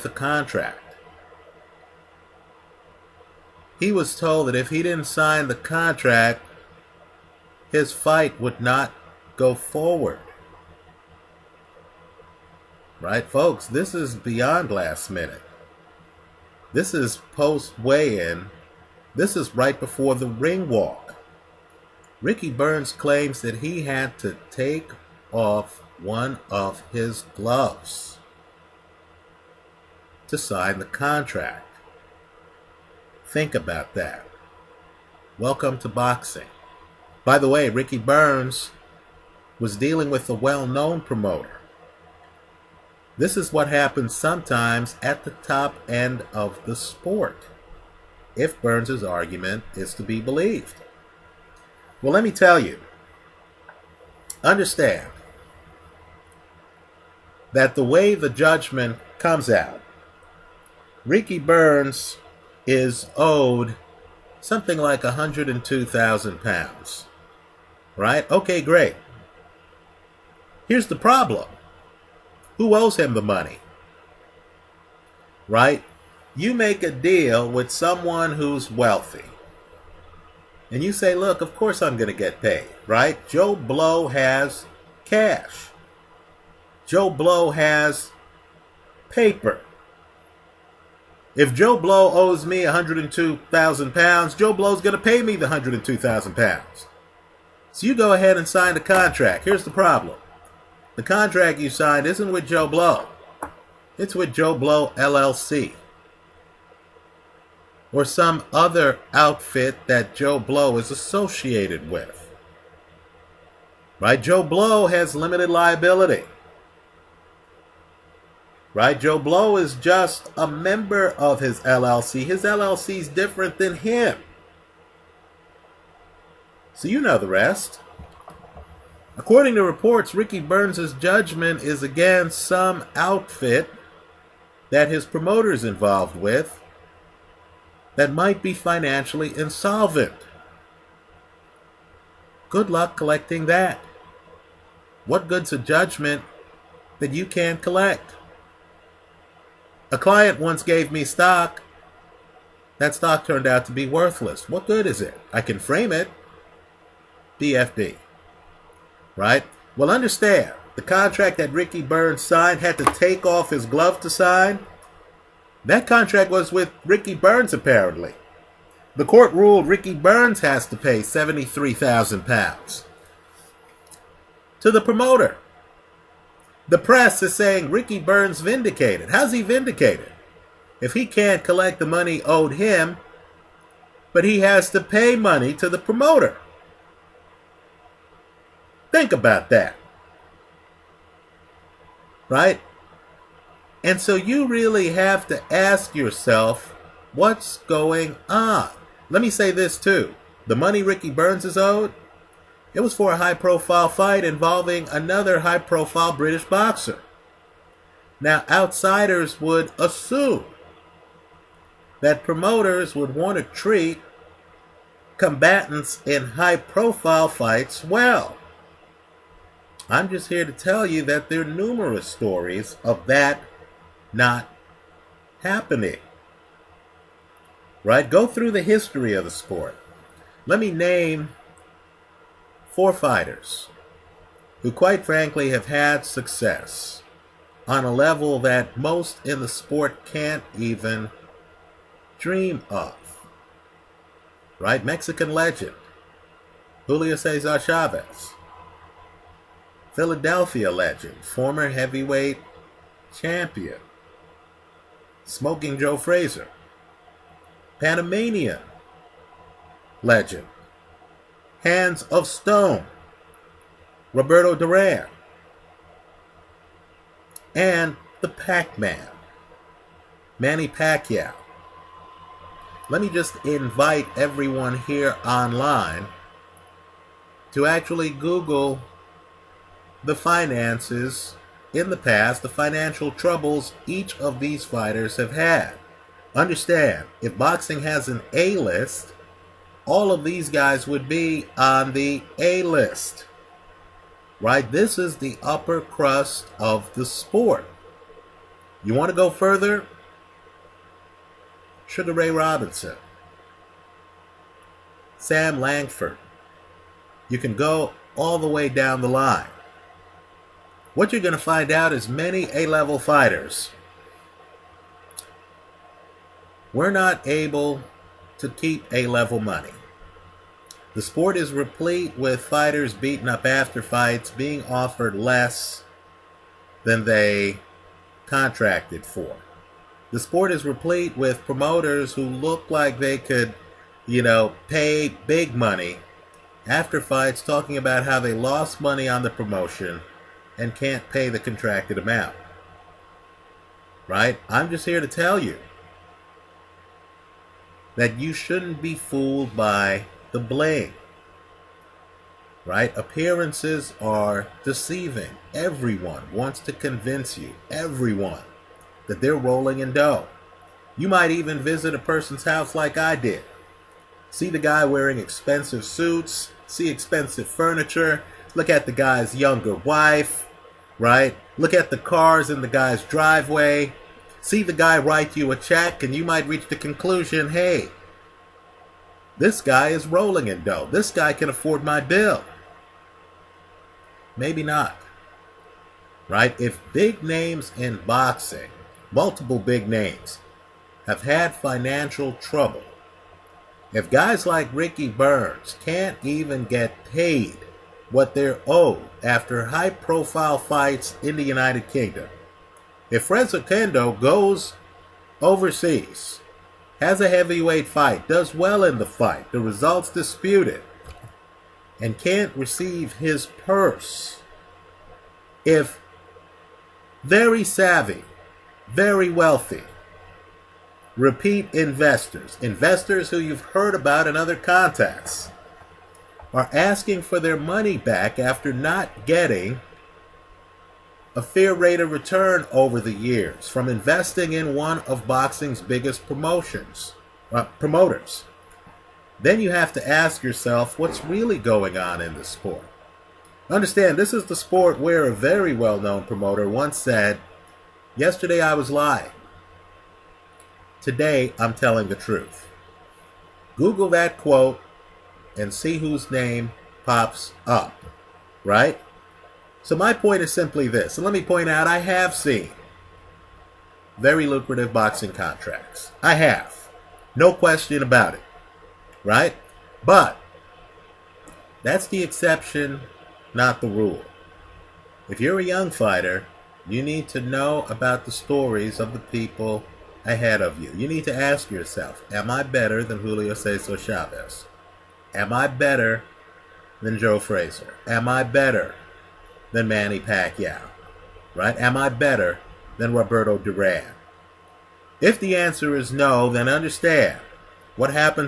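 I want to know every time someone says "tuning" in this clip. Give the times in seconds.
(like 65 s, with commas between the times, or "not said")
not said.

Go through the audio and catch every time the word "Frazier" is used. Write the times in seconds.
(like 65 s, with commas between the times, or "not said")
255 s, 487 s.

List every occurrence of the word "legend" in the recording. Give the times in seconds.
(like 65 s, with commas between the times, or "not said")
245 s, 250 s, 260 s.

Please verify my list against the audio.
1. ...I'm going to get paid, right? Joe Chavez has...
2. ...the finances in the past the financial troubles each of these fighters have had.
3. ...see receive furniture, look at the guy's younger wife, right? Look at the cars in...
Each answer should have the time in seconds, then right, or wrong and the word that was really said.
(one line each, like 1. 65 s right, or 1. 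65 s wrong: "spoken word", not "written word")
1. 81 s wrong: "Blow", not "Chavez"
2. 280 s right
3. 366 s wrong: "expensive", not "receive".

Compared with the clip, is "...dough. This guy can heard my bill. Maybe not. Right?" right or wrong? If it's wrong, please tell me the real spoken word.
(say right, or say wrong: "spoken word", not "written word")
wrong: "afford", not "heard".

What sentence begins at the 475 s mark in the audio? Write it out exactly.
If you're a young fighter, you need to know about the stories of the people ahead of you.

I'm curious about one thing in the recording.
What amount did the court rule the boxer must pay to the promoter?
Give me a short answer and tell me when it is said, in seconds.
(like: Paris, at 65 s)
£73,000, at 170 s.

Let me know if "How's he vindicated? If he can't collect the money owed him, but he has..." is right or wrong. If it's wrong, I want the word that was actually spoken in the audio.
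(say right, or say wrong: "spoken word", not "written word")
right.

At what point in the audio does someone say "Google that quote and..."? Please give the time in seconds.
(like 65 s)
453 s.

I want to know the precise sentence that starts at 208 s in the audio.
Now, outsiders would assume that promoters would want to treat combatants in high profile fights well.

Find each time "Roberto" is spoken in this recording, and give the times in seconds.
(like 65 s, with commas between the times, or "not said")
264 s, 493 s.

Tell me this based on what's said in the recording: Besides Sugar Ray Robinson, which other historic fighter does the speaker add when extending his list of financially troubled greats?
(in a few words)
Sam Langford.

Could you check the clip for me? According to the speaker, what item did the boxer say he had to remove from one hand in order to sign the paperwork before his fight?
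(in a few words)
gloves.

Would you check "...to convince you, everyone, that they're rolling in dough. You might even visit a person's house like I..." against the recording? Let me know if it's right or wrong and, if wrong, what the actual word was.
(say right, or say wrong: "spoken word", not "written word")
right.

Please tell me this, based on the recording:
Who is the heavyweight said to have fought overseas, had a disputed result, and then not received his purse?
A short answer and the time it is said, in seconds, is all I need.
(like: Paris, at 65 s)
Fres Oquendo, at 403 s.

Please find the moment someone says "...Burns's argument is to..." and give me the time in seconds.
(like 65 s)
48 s.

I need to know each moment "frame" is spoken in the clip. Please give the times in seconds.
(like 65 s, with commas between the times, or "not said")
155 s.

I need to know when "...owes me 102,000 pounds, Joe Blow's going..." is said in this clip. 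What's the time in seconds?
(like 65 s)
92 s.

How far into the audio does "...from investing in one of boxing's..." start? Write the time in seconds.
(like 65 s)
433 s.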